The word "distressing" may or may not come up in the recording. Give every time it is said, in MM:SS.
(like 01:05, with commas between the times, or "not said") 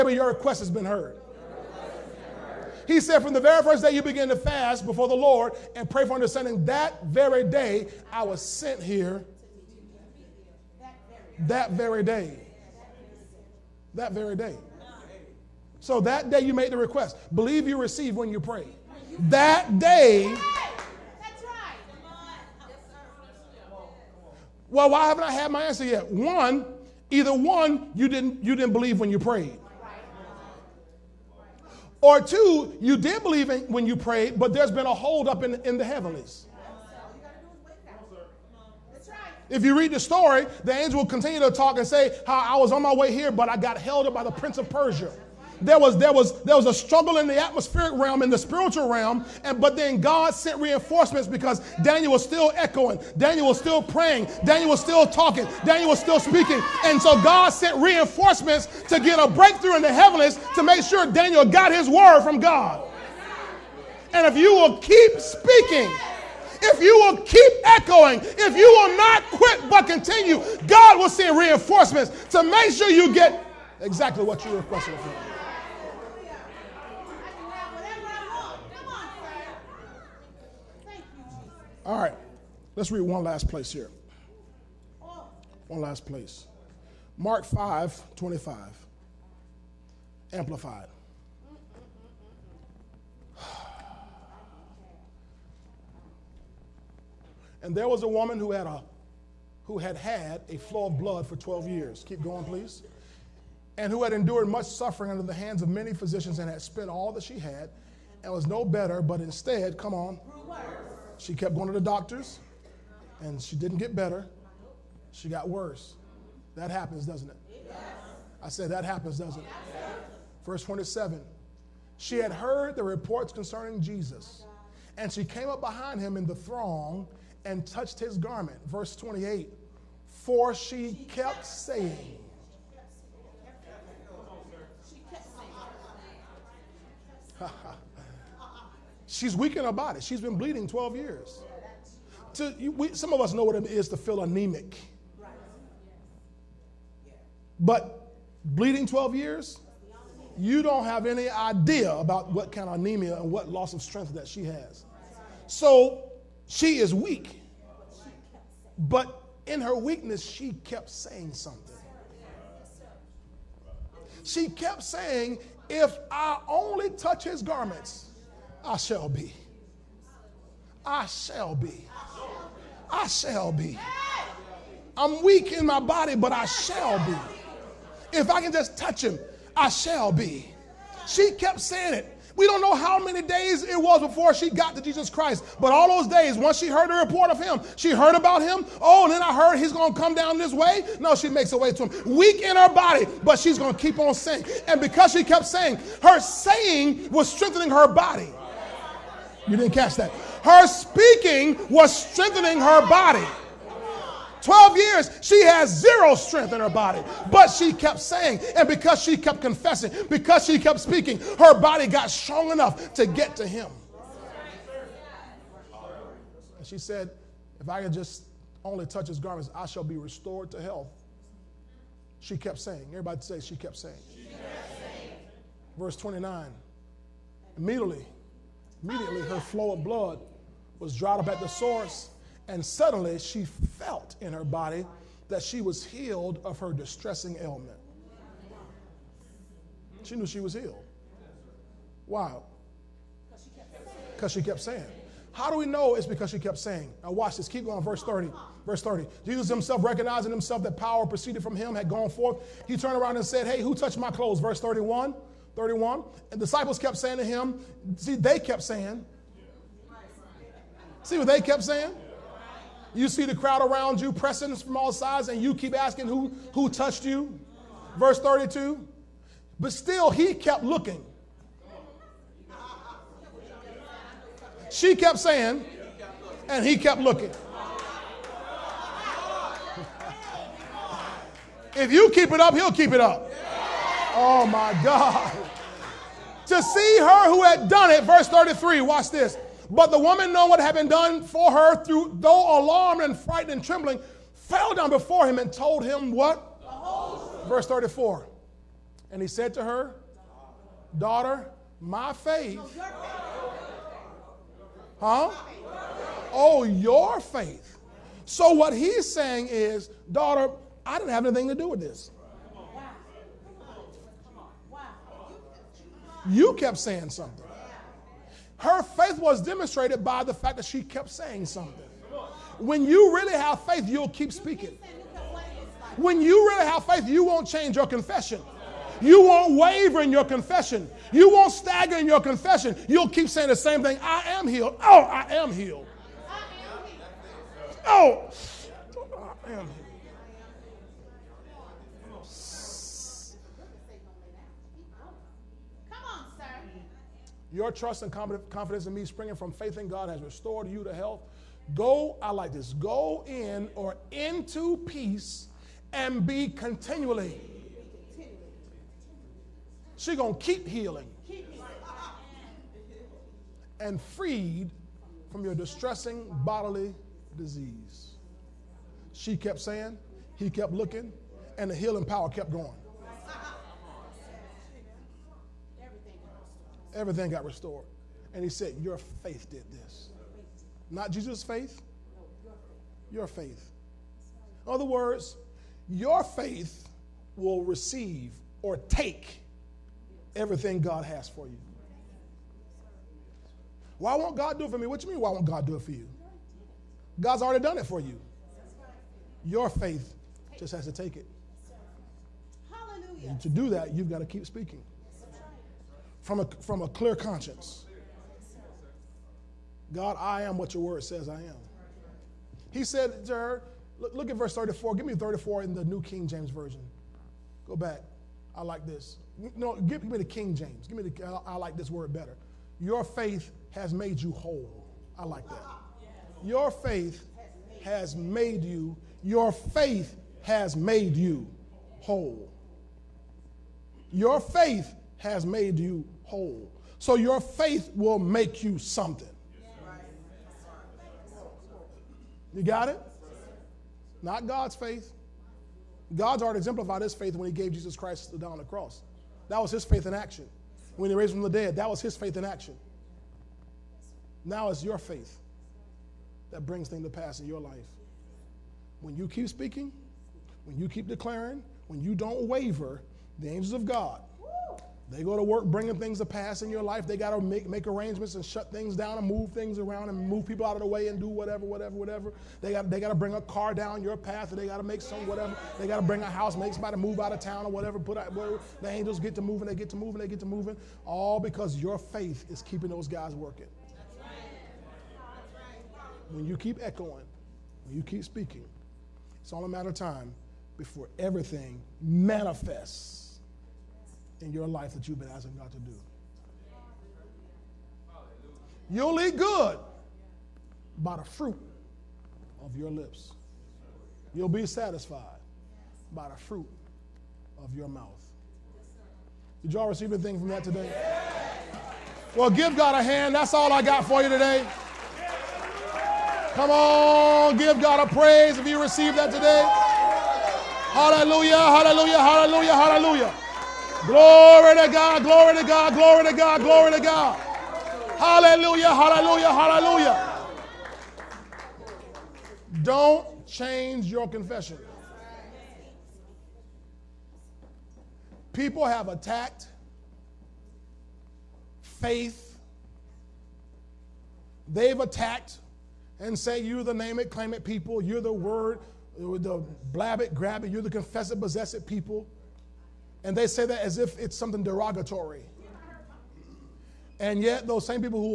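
03:56, 06:05.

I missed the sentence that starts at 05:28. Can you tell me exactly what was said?
You won't waver in your confession.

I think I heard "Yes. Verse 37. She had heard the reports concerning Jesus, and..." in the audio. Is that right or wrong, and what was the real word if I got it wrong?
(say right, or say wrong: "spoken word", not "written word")
wrong: "27", not "37".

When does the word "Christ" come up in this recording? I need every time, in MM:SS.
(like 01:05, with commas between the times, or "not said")
03:05, 07:27.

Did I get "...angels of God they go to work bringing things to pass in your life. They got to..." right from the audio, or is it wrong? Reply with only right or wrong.
right.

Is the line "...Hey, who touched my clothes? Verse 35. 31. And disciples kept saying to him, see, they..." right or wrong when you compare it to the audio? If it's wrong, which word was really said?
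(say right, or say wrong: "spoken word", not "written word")
wrong: "31", not "35".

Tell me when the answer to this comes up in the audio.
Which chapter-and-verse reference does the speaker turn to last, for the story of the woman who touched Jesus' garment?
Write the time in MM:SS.
01:27.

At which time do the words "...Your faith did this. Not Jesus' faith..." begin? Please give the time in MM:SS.
06:18.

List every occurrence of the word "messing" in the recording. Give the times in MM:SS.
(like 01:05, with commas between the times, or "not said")
not said.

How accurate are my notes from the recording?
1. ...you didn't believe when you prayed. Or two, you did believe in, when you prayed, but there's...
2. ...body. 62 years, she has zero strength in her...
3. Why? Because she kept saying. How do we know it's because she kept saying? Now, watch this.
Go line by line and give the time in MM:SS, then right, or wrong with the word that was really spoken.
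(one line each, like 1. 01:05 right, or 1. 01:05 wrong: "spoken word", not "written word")
1. 00:28 right
2. 03:22 wrong: "12", not "62"
3. 04:02 right.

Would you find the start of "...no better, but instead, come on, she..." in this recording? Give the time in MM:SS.
01:48.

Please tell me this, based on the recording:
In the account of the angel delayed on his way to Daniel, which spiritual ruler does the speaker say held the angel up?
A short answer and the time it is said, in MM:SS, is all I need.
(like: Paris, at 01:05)
Prince of Persia, at 00:44.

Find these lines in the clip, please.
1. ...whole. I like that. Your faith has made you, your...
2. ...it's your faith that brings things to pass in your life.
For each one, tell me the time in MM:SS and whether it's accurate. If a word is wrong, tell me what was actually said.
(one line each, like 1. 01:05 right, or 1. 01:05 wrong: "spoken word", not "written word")
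1. 07:04 right
2. 07:34 right.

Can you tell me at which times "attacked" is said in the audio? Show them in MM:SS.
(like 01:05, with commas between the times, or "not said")
08:59, 09:04.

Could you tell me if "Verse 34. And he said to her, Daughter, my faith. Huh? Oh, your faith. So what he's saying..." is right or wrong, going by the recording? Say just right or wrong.
right.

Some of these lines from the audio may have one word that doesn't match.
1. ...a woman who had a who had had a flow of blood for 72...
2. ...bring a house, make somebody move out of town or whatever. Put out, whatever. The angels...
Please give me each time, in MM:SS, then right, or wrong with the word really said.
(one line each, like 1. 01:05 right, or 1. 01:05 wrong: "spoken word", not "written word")
1. 01:38 wrong: "12", not "72"
2. 07:56 right.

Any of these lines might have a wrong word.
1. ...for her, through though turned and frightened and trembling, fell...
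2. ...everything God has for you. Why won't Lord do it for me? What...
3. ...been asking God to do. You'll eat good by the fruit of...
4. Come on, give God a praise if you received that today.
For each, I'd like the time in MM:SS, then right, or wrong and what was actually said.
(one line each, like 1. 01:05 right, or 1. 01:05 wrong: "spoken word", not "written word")
1. 04:51 wrong: "alarmed", not "turned"
2. 06:30 wrong: "God", not "Lord"
3. 08:15 right
4. 08:36 right.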